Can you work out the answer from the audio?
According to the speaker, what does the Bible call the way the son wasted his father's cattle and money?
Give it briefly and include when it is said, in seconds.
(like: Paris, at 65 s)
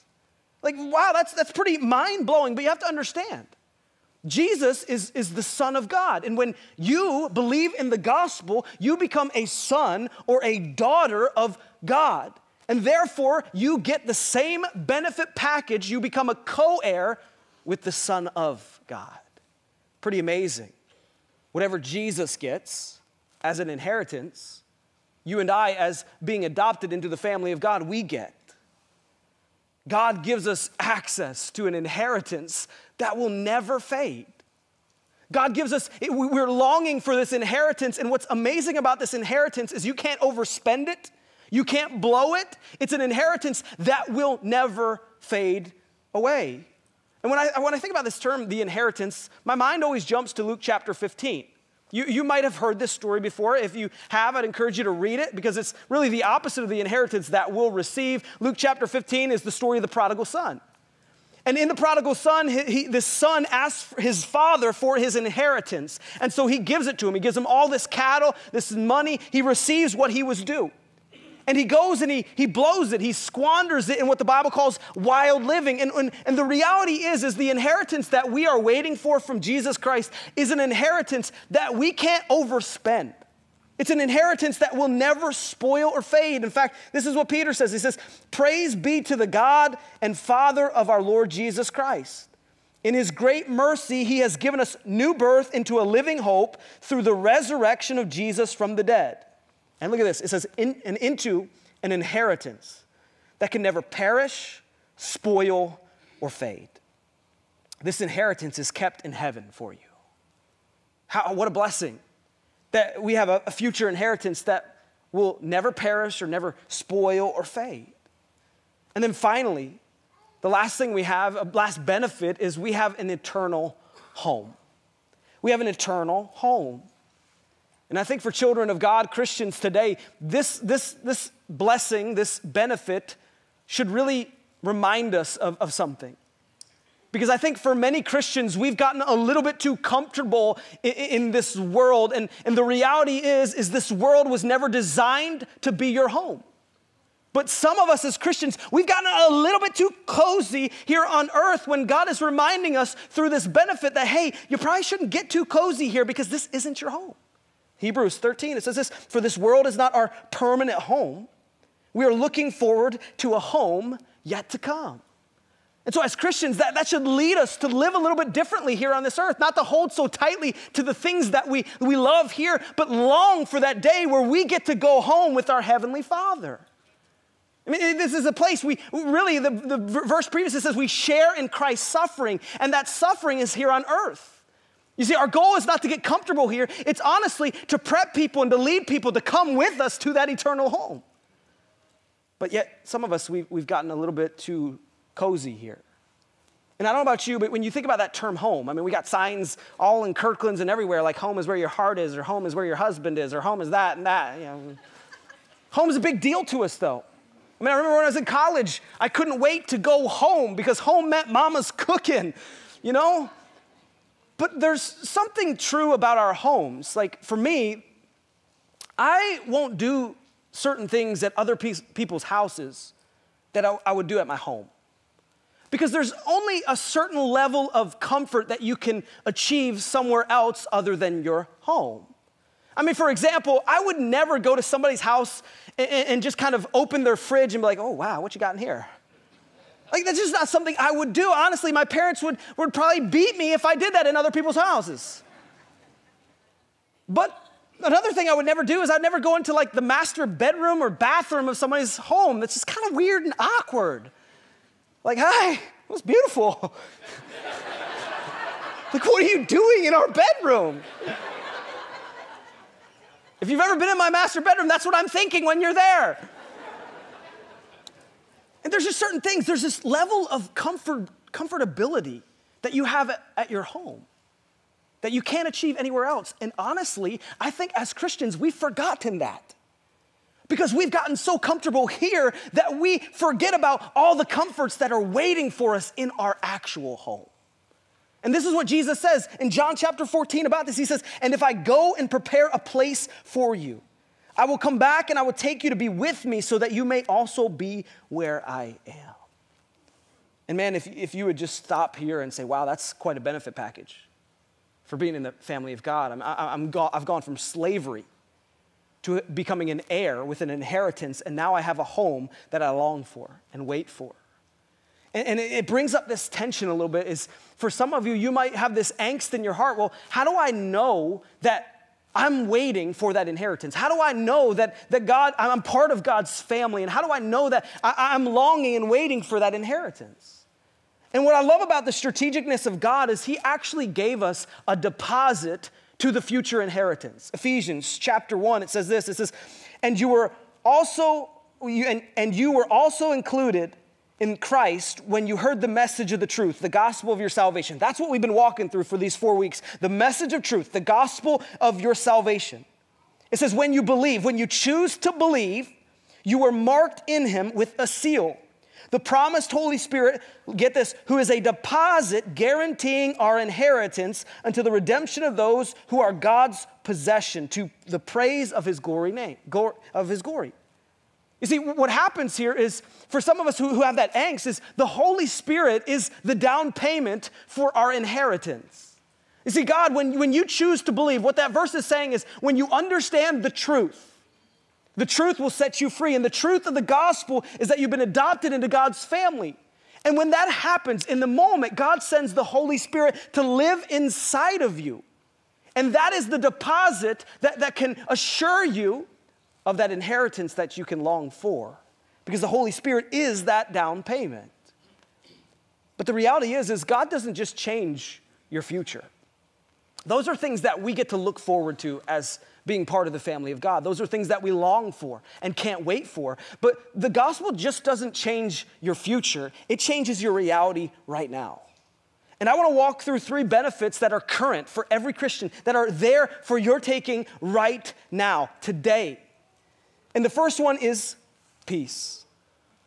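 Wild living, at 74 s.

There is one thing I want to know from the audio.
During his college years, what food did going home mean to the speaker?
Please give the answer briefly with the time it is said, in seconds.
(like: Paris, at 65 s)
Mama's cooking, at 211 s.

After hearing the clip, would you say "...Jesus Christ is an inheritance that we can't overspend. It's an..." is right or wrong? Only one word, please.
right.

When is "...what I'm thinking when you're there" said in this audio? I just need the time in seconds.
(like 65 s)
264 s.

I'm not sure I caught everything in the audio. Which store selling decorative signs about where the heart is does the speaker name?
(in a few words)
Kirkland's.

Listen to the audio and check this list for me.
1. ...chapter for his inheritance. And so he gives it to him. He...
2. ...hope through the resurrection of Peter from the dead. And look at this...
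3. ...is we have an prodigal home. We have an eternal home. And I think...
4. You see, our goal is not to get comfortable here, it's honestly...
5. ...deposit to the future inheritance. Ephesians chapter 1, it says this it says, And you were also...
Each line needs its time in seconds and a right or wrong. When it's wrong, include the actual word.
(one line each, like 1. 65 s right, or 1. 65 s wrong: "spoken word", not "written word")
1. 64 s wrong: "father", not "chapter"
2. 96 s wrong: "Jesus", not "Peter"
3. 122 s wrong: "eternal", not "prodigal"
4. 184 s right
5. 334 s right.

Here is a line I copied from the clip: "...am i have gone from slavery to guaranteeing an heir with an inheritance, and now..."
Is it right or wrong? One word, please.
wrong.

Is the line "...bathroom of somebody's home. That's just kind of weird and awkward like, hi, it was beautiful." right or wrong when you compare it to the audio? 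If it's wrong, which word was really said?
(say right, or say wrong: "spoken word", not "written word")
right.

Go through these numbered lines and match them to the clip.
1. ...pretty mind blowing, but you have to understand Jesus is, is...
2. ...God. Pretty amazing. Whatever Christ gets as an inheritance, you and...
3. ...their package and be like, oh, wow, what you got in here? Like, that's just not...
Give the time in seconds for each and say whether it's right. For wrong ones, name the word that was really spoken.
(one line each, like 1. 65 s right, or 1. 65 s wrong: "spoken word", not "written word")
1. 1 s right
2. 18 s wrong: "Jesus", not "Christ"
3. 237 s wrong: "fridge", not "package".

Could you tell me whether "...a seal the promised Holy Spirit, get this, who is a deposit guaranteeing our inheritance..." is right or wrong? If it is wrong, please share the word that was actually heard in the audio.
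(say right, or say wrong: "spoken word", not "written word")
right.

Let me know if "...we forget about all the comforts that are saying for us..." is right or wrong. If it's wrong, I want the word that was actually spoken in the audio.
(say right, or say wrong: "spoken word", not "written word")
wrong: "waiting", not "saying".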